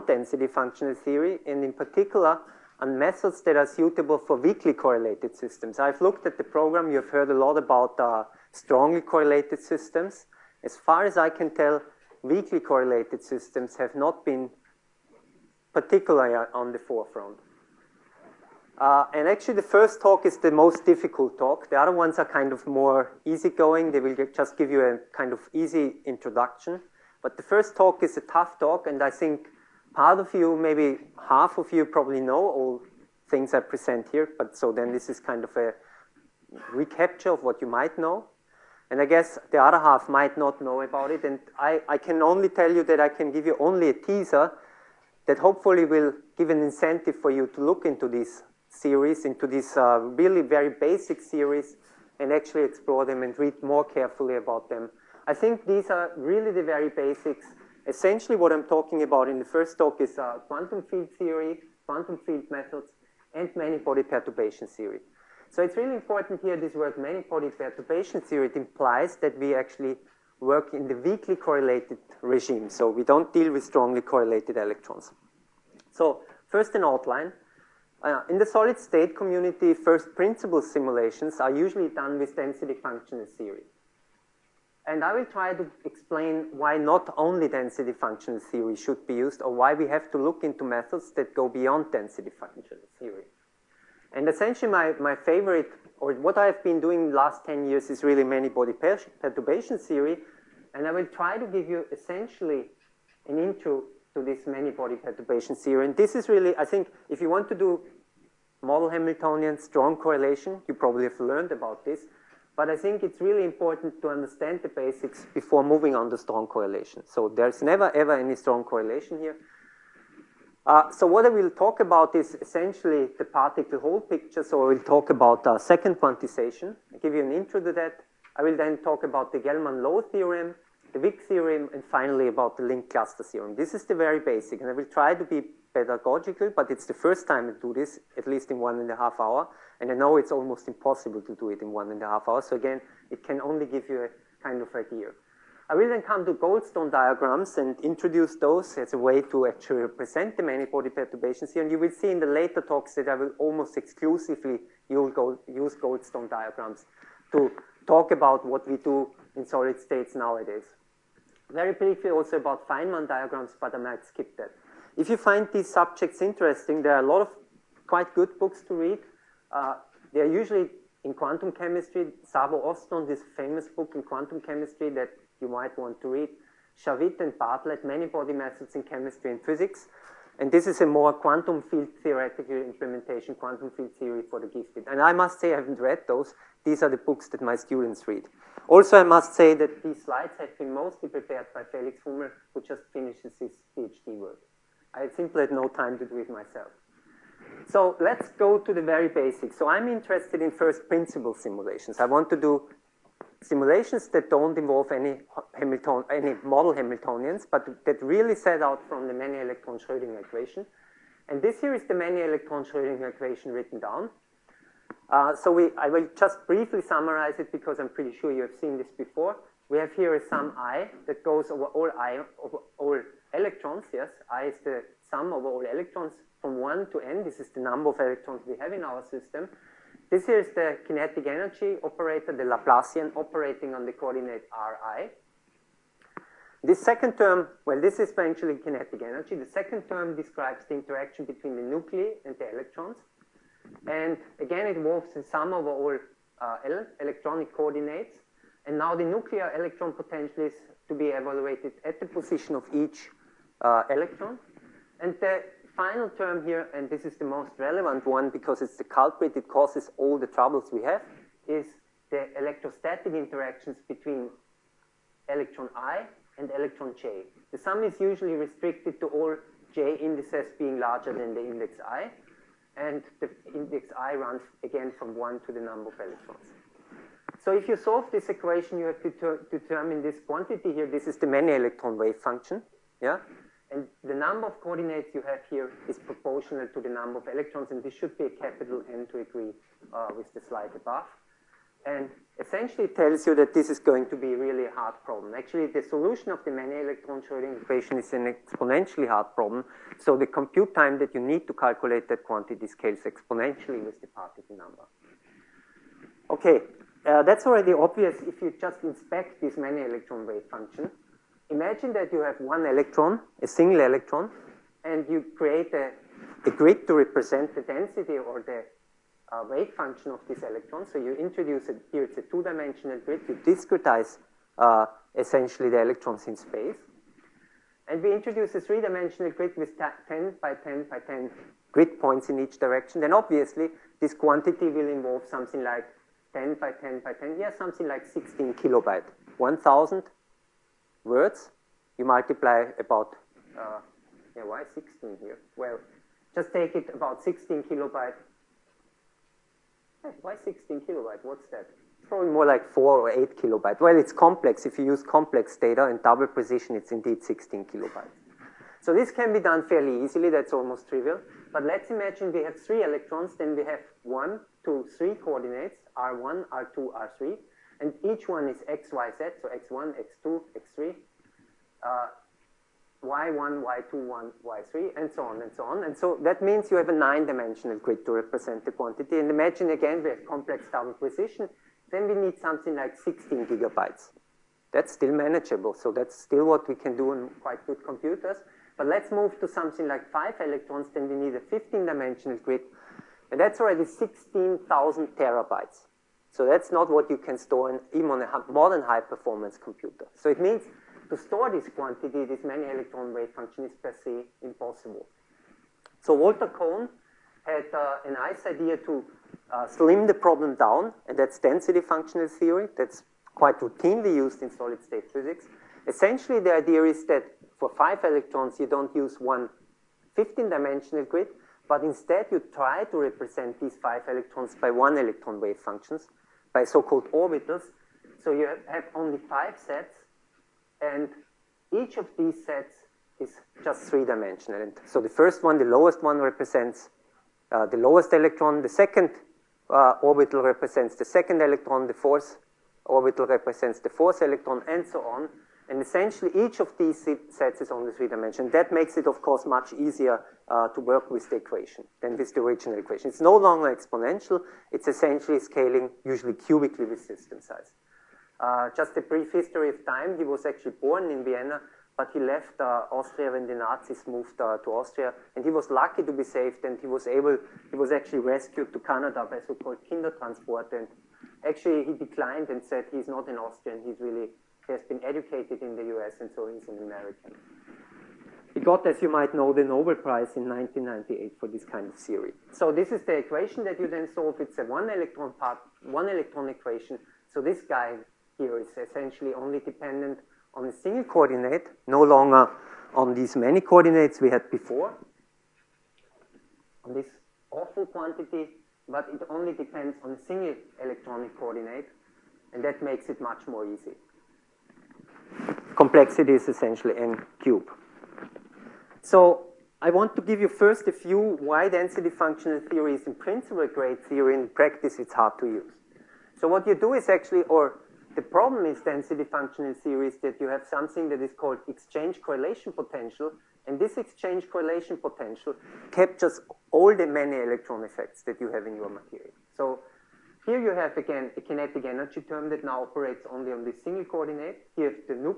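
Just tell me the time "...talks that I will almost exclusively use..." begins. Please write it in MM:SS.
02:32.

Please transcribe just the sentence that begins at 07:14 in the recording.
And so the first one, the lowest one, represents uh, the lowest electron.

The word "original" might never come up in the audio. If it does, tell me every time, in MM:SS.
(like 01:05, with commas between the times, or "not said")
07:32.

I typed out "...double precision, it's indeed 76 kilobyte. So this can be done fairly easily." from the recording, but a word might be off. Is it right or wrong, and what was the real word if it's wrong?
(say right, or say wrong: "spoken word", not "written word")
wrong: "16", not "76".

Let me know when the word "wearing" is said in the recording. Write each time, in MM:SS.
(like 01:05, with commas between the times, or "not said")
not said.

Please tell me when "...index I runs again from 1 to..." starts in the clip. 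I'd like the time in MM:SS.
04:33.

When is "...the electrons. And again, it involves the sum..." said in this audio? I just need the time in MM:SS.
04:02.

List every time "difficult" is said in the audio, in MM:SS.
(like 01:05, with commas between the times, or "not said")
00:20.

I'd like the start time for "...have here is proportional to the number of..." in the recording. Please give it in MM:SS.
04:45.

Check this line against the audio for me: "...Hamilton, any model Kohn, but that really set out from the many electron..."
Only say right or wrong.
wrong.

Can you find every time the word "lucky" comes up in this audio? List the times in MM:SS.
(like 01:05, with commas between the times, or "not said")
07:45.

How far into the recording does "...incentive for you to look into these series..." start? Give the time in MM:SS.
00:46.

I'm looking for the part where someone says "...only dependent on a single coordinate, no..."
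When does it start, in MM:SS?
08:09.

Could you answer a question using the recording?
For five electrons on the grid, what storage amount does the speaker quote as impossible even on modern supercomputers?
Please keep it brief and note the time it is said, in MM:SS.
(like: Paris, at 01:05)
16,000 terabytes, at 06:33.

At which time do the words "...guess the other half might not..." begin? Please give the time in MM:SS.
00:39.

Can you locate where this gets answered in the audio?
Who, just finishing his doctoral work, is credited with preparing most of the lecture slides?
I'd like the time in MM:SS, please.
03:11.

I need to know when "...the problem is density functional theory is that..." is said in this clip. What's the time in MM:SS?
08:38.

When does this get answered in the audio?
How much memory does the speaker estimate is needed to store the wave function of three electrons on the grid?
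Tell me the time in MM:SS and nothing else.
06:22.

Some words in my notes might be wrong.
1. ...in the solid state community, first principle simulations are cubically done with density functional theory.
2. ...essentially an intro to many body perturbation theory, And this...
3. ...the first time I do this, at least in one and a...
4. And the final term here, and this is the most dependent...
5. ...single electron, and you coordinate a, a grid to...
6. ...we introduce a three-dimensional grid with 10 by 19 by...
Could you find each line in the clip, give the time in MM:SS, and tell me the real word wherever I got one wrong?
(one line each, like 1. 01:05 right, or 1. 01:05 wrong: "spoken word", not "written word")
1. 01:18 wrong: "usually", not "cubically"
2. 01:41 right
3. 02:16 right
4. 04:15 wrong: "relevant", not "dependent"
5. 05:13 wrong: "create", not "coordinate"
6. 05:28 wrong: "10", not "19".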